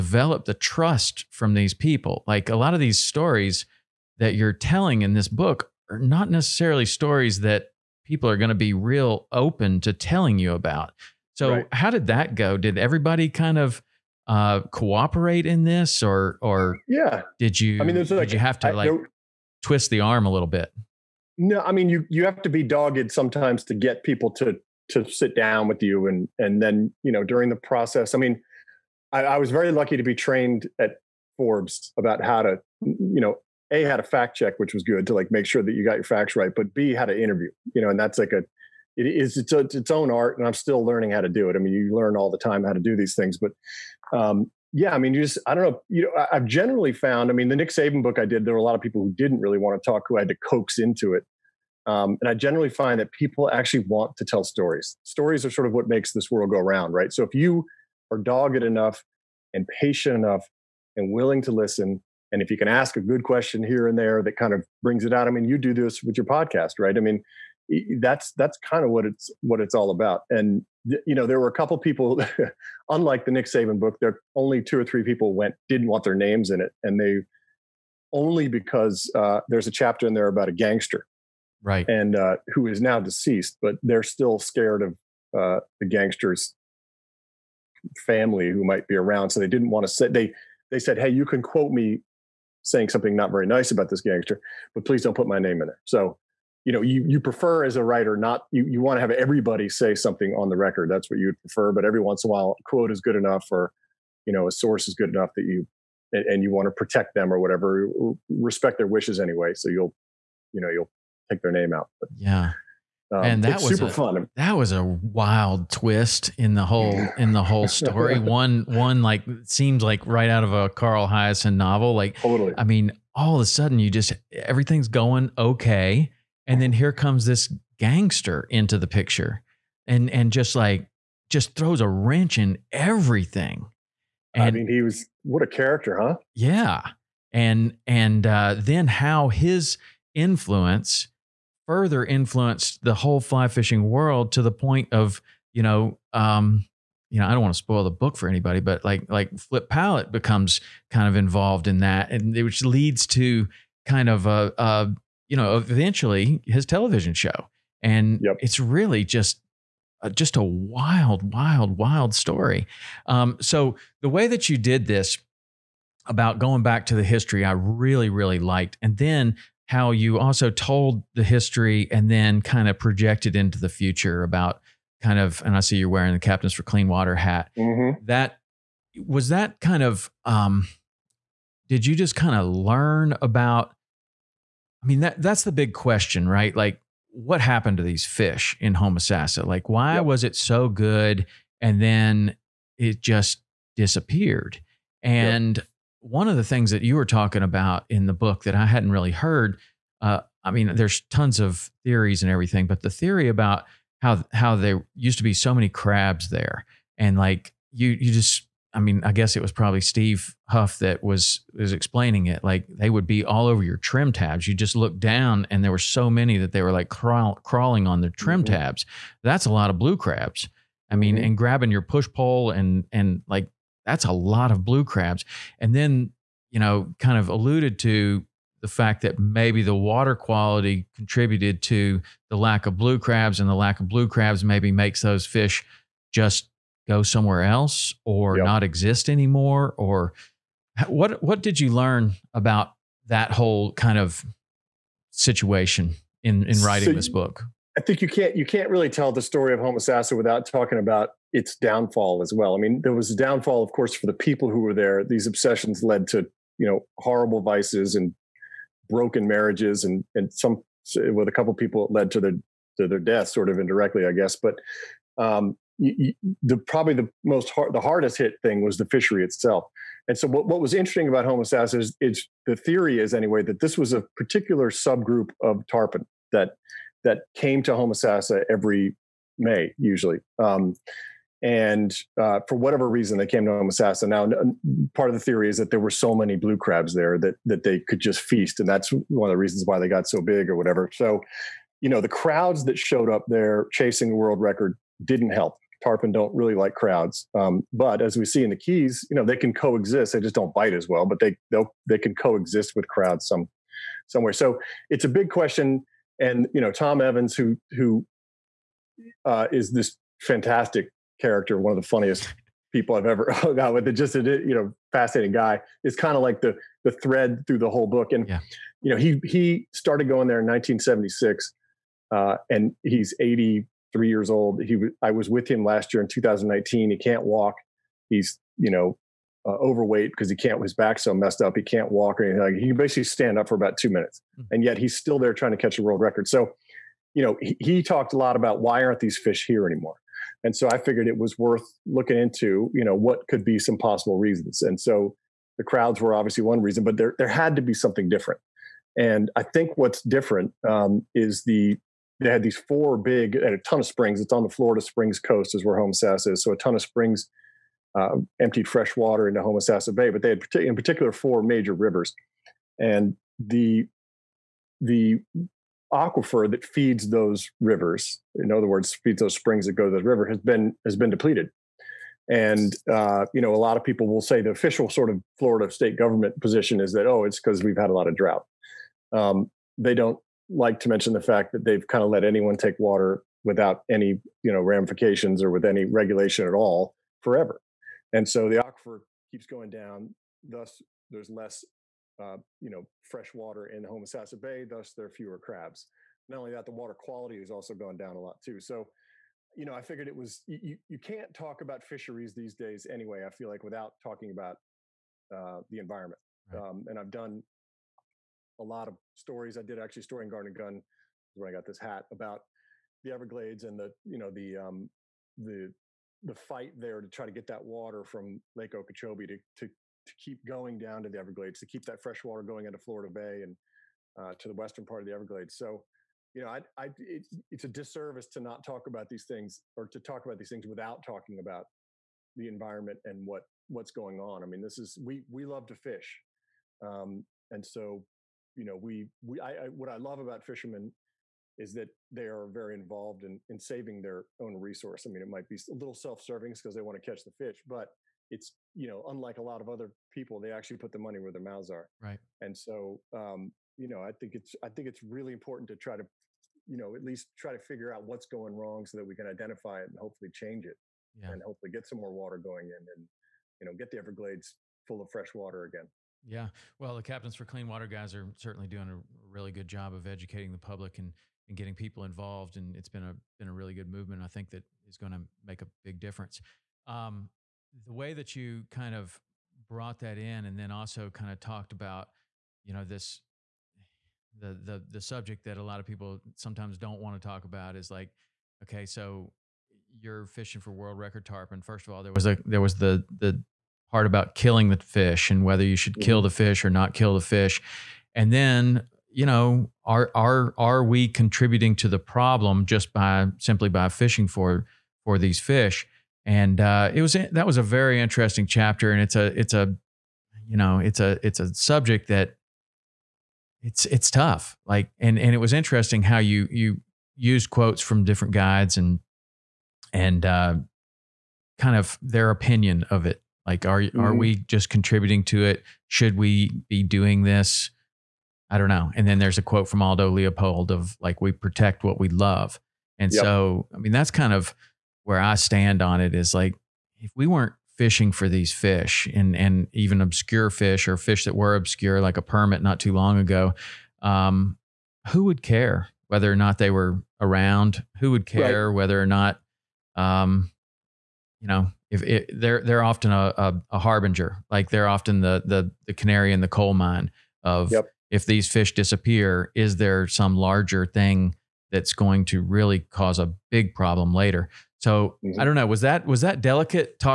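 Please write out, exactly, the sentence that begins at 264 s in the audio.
But um, you, you, the probably the most hard, the hardest hit thing was the fishery itself.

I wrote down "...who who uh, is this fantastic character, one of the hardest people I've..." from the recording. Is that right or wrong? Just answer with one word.
wrong.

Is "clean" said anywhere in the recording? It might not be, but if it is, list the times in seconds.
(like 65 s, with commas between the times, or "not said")
176 s, 467 s.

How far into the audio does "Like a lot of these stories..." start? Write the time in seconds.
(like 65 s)
2 s.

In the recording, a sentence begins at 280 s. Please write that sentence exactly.
Um, and uh, for whatever reason they came to Homosassa.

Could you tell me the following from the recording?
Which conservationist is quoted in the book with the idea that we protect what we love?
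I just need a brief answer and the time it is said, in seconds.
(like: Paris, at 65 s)
Aldo Leopold, at 529 s.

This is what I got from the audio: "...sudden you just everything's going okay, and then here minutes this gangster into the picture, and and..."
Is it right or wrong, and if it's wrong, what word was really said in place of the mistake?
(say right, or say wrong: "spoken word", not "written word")
wrong: "comes", not "minutes".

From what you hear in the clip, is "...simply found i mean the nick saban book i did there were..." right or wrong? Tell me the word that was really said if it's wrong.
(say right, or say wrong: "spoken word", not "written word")
wrong: "generally", not "simply".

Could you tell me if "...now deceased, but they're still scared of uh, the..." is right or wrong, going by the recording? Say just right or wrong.
right.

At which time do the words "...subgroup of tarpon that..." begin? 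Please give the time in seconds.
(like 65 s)
274 s.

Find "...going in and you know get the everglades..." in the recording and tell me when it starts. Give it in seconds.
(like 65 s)
462 s.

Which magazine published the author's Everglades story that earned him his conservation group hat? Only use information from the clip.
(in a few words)
Garden and Gun.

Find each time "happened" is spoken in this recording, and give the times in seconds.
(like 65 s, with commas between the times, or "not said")
187 s.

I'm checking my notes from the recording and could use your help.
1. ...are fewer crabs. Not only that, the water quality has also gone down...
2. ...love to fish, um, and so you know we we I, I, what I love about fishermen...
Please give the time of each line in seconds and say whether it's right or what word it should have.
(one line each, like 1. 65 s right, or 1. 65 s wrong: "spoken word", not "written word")
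1. 395 s right
2. 435 s right.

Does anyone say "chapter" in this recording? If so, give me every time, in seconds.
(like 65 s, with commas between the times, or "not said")
79 s, 508 s.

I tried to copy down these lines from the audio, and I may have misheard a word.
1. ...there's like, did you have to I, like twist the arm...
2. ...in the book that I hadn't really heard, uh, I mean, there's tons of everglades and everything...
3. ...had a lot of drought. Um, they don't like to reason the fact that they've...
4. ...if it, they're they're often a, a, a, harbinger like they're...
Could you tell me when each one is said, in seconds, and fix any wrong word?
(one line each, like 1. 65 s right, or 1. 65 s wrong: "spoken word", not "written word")
1. 17 s right
2. 197 s wrong: "theories", not "everglades"
3. 377 s wrong: "mention", not "reason"
4. 551 s right.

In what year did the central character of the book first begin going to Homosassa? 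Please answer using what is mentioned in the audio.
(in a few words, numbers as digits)
1976.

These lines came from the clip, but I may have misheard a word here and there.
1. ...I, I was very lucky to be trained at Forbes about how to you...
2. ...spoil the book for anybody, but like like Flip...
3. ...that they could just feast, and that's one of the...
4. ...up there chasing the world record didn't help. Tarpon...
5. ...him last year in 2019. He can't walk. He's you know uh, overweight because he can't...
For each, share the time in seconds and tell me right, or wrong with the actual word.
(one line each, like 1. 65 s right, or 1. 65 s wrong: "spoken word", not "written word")
1. 29 s right
2. 147 s right
3. 287 s right
4. 293 s right
5. 325 s right.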